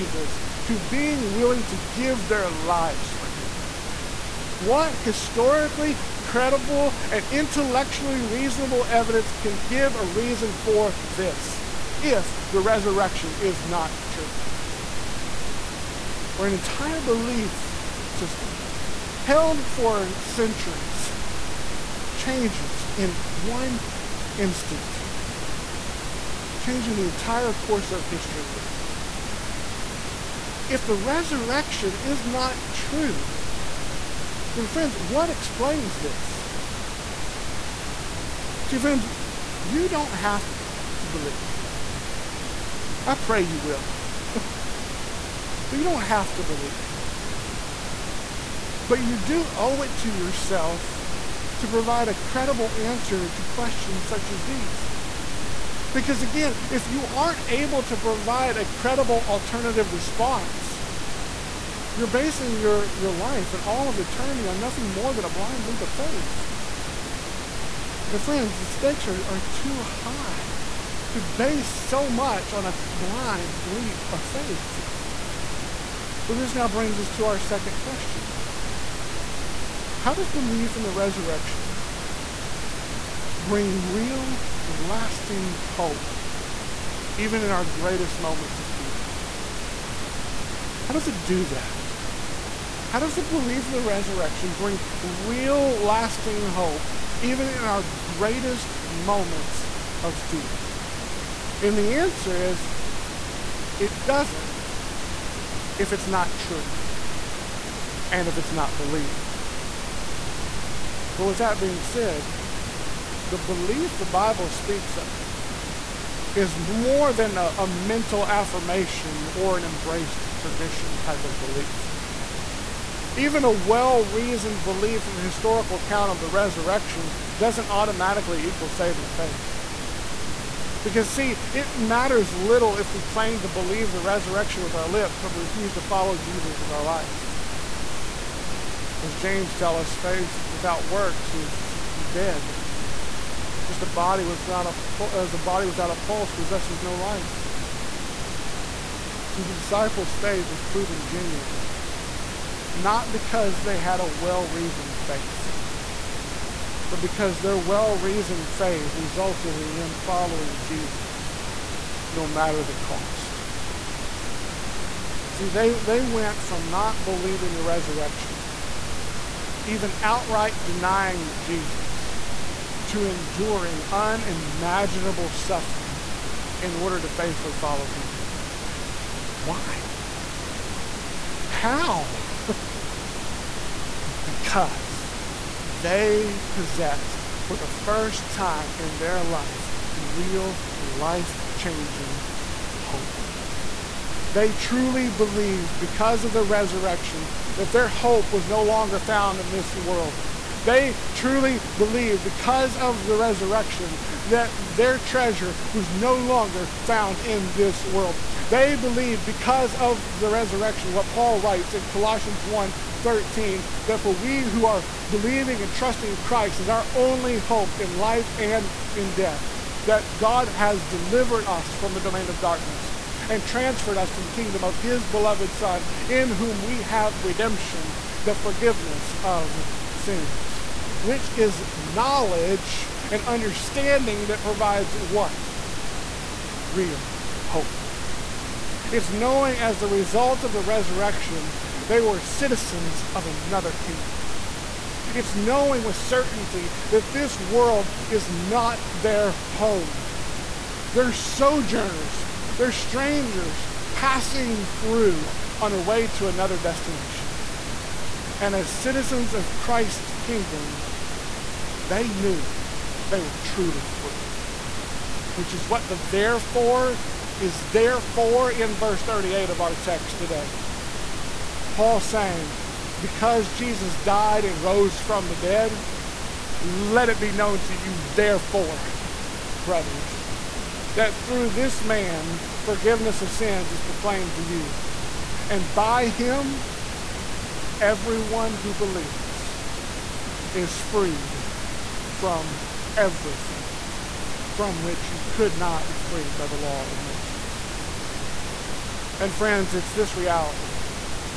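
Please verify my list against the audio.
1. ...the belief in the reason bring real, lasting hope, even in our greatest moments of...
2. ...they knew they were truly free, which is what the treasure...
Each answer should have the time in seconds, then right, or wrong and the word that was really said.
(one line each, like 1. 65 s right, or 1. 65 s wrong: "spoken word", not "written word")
1. 93 s wrong: "resurrection", not "reason"
2. 261 s wrong: "therefore", not "treasure".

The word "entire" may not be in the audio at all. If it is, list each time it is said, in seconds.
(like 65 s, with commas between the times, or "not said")
16 s, 27 s.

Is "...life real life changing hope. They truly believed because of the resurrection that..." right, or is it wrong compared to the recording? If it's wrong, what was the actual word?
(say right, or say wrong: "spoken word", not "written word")
right.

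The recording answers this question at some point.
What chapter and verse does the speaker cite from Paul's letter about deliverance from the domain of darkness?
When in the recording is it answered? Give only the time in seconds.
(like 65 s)
211 s.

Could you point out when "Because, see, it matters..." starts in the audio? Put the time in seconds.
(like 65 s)
130 s.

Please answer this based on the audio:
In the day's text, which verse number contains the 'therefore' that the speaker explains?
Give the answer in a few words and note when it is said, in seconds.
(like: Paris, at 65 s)
38, at 269 s.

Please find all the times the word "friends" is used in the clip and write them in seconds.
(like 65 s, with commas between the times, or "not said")
34 s, 38 s, 68 s, 299 s.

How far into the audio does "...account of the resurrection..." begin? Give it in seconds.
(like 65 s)
125 s.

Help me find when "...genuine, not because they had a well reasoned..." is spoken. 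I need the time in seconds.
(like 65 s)
151 s.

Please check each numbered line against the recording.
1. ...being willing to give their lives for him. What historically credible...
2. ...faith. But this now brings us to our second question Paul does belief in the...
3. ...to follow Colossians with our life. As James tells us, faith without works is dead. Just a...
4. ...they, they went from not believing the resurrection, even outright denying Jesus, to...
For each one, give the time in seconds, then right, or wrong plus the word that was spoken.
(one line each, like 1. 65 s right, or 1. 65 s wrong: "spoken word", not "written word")
1. 0 s right
2. 74 s wrong: "How", not "Paul"
3. 135 s wrong: "Jesus", not "Colossians"
4. 165 s right.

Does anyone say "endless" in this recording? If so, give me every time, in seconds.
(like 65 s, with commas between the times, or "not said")
not said.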